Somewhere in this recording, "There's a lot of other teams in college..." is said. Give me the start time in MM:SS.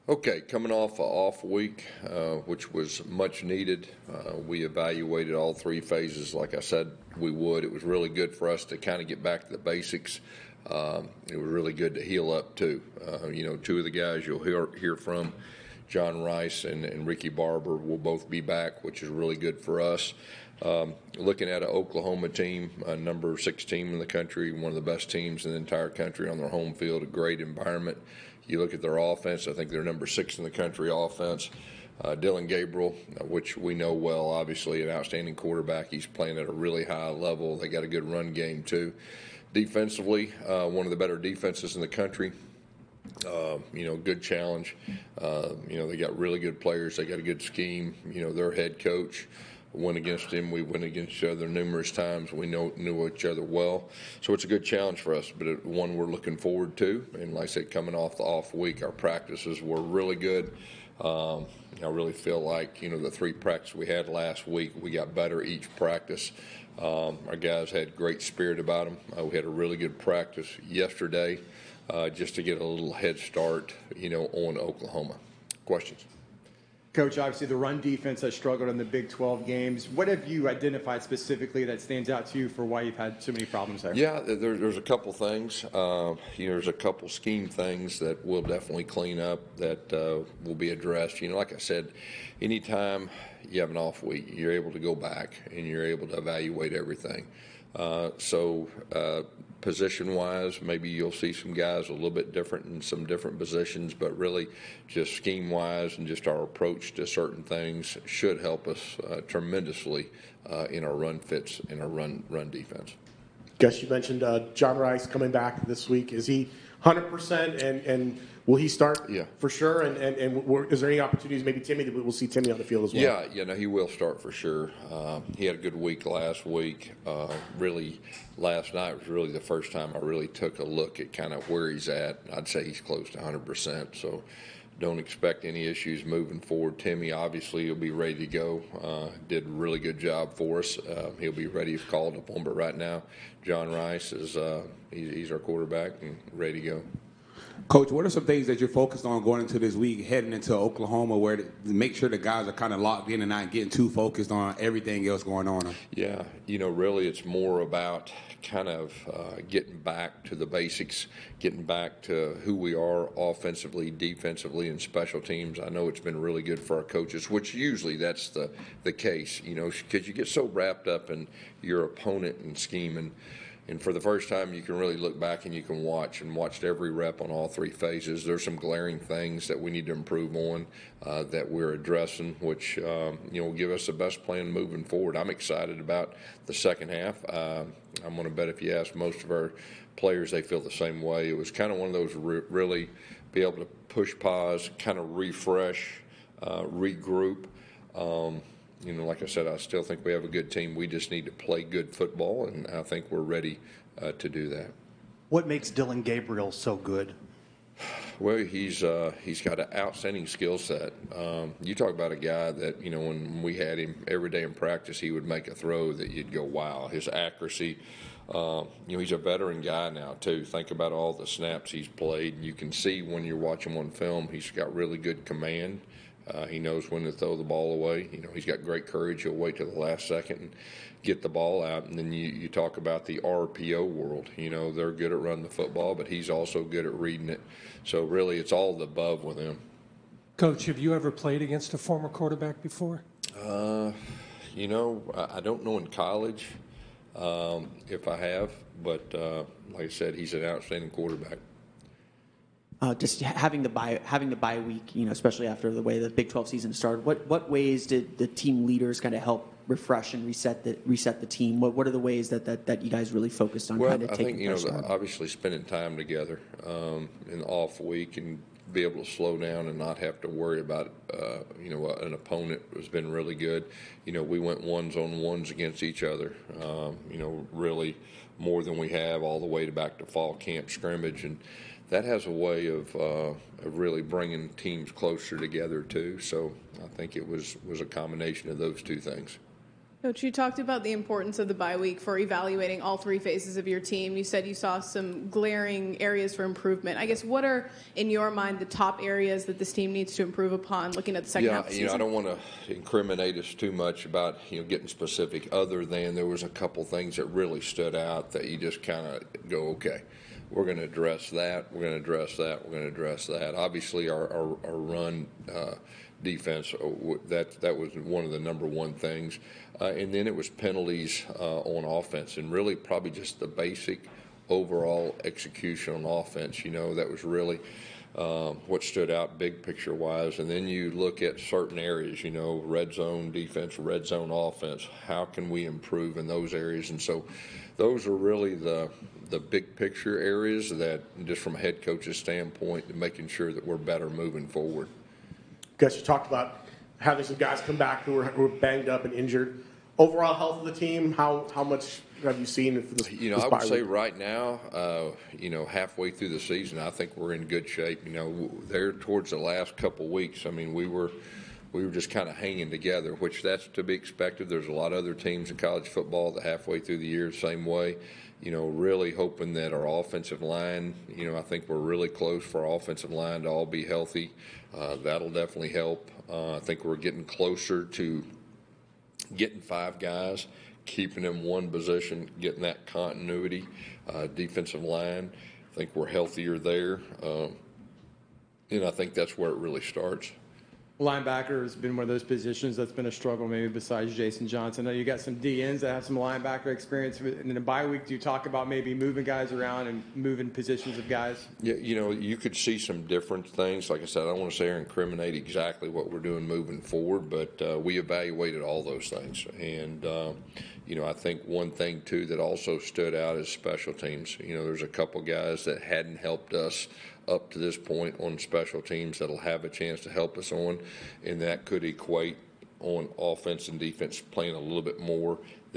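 06:04.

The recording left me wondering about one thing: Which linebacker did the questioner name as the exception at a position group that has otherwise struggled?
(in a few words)
Jason Johnson.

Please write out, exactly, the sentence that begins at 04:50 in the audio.
Coach, you talked about the importance of the bye week for evaluating all three phases of your team.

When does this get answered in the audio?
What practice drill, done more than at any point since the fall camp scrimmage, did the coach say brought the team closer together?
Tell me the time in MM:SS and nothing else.
04:34.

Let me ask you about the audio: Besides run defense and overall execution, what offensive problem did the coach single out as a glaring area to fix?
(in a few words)
penalties.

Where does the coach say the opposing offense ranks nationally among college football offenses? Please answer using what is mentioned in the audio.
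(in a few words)
6th.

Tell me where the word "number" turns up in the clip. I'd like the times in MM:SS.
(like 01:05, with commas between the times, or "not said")
00:22, 00:29, 05:18.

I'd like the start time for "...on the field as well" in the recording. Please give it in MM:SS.
02:02.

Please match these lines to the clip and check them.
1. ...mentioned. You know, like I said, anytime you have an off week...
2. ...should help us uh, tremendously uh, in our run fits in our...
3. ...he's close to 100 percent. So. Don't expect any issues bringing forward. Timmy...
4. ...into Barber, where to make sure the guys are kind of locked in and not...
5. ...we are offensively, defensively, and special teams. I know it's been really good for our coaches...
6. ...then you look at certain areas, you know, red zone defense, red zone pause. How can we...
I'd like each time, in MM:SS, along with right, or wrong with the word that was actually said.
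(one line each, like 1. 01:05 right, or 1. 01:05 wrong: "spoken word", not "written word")
1. 01:30 wrong: "addressed", not "mentioned"
2. 01:48 right
3. 02:12 wrong: "moving", not "bringing"
4. 02:30 wrong: "Oklahoma", not "Barber"
5. 02:42 right
6. 05:30 wrong: "offense", not "pause".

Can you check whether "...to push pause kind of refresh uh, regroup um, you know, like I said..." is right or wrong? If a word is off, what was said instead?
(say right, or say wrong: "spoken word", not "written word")
right.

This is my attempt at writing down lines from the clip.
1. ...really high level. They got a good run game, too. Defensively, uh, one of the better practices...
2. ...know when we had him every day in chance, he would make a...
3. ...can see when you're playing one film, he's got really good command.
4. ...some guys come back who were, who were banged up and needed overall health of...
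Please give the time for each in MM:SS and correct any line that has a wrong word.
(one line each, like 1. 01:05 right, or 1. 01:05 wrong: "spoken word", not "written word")
1. 00:36 wrong: "defenses", not "practices"
2. 03:32 wrong: "practice", not "chance"
3. 03:42 wrong: "watching", not "playing"
4. 05:47 wrong: "injured", not "needed".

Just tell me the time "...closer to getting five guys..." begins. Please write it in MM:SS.
06:17.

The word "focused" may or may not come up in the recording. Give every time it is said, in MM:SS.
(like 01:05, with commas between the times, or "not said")
02:28, 02:33, 04:23.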